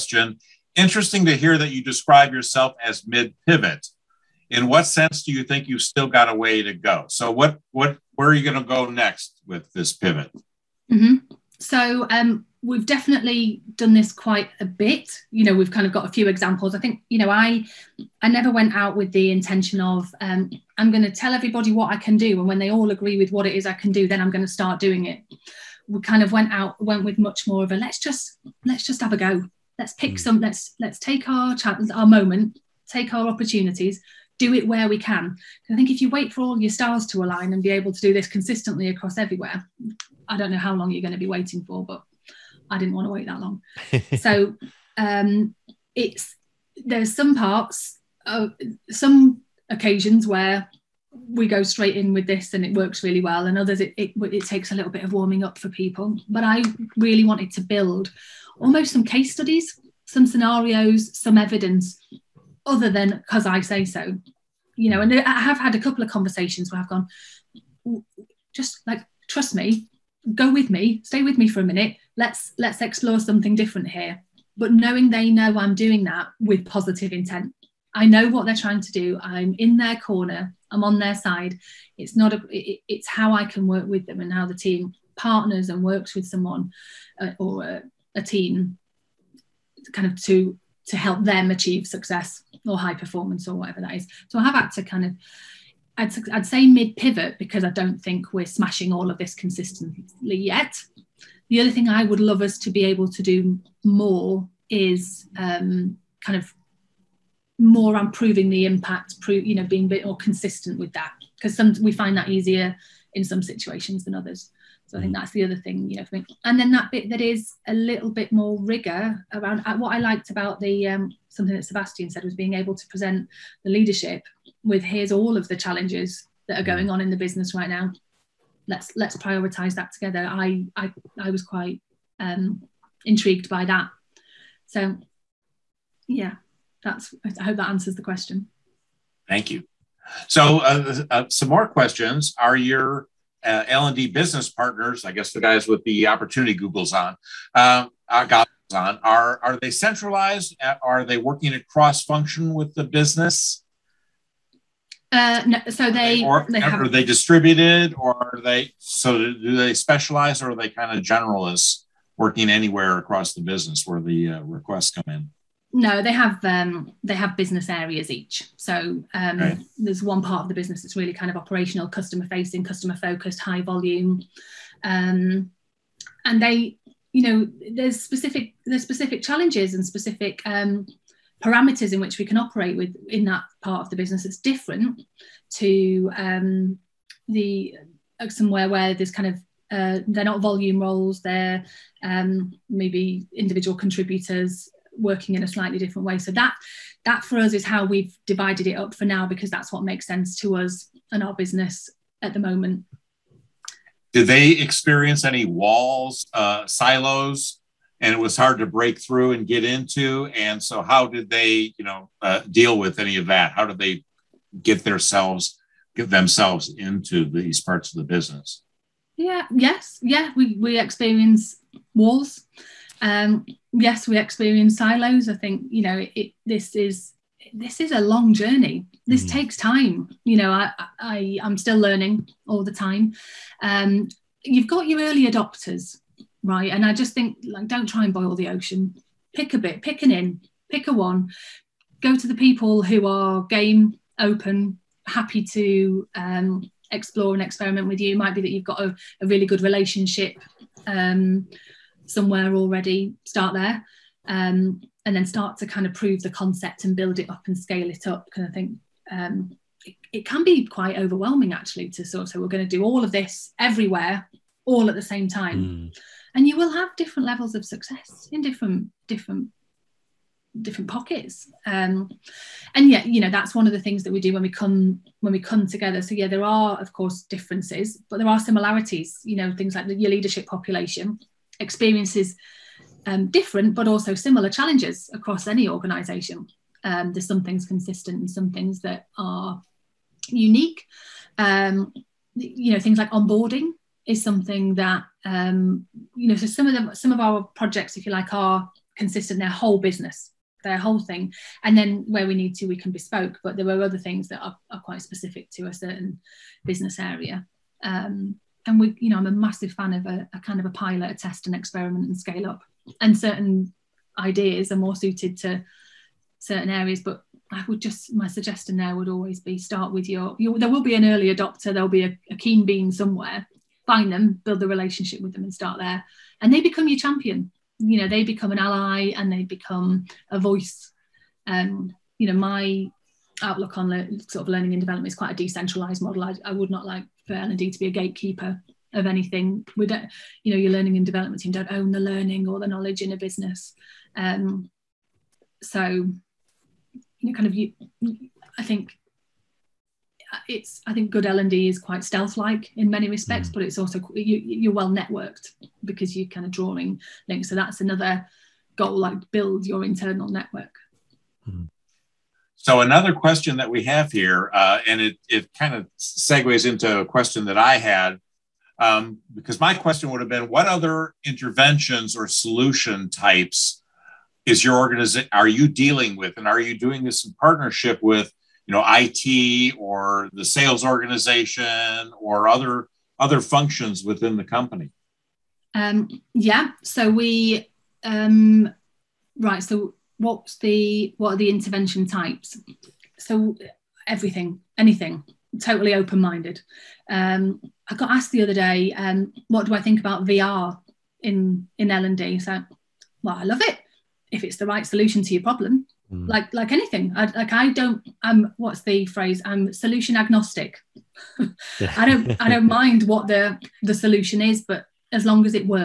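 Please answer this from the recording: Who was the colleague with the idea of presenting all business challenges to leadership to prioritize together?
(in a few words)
Sebastian.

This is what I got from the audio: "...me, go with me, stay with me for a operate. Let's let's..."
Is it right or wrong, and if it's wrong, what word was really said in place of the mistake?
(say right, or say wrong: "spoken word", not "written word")
wrong: "minute", not "operate".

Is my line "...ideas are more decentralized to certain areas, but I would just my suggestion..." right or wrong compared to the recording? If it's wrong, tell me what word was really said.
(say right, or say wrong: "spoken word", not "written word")
wrong: "suited", not "decentralized".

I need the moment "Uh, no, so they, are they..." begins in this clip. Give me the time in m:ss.
2:35.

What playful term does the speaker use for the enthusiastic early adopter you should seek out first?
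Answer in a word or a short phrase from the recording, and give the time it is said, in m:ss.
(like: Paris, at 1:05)
Keen bean, at 5:22.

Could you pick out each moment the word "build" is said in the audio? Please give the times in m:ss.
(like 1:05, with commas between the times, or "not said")
0:57, 4:16, 5:24, 5:59.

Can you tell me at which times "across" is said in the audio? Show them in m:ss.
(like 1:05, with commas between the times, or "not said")
0:38, 2:31, 2:42, 4:45.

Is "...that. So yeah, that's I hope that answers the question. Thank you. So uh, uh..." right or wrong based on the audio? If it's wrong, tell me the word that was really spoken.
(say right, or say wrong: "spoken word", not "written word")
right.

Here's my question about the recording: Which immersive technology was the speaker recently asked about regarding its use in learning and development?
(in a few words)
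VR.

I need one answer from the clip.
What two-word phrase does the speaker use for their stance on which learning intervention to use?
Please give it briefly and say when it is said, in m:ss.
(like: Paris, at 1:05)
Solution agnostic, at 6:49.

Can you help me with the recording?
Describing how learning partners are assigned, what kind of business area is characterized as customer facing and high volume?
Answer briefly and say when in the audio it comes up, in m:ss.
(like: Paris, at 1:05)
Operational, at 2:51.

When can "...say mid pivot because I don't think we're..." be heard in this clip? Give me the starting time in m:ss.
1:36.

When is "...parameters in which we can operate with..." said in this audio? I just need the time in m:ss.
3:01.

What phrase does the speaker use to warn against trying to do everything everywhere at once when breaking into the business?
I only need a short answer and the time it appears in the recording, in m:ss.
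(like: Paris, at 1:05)
Don't try and boil the ocean, at 3:57.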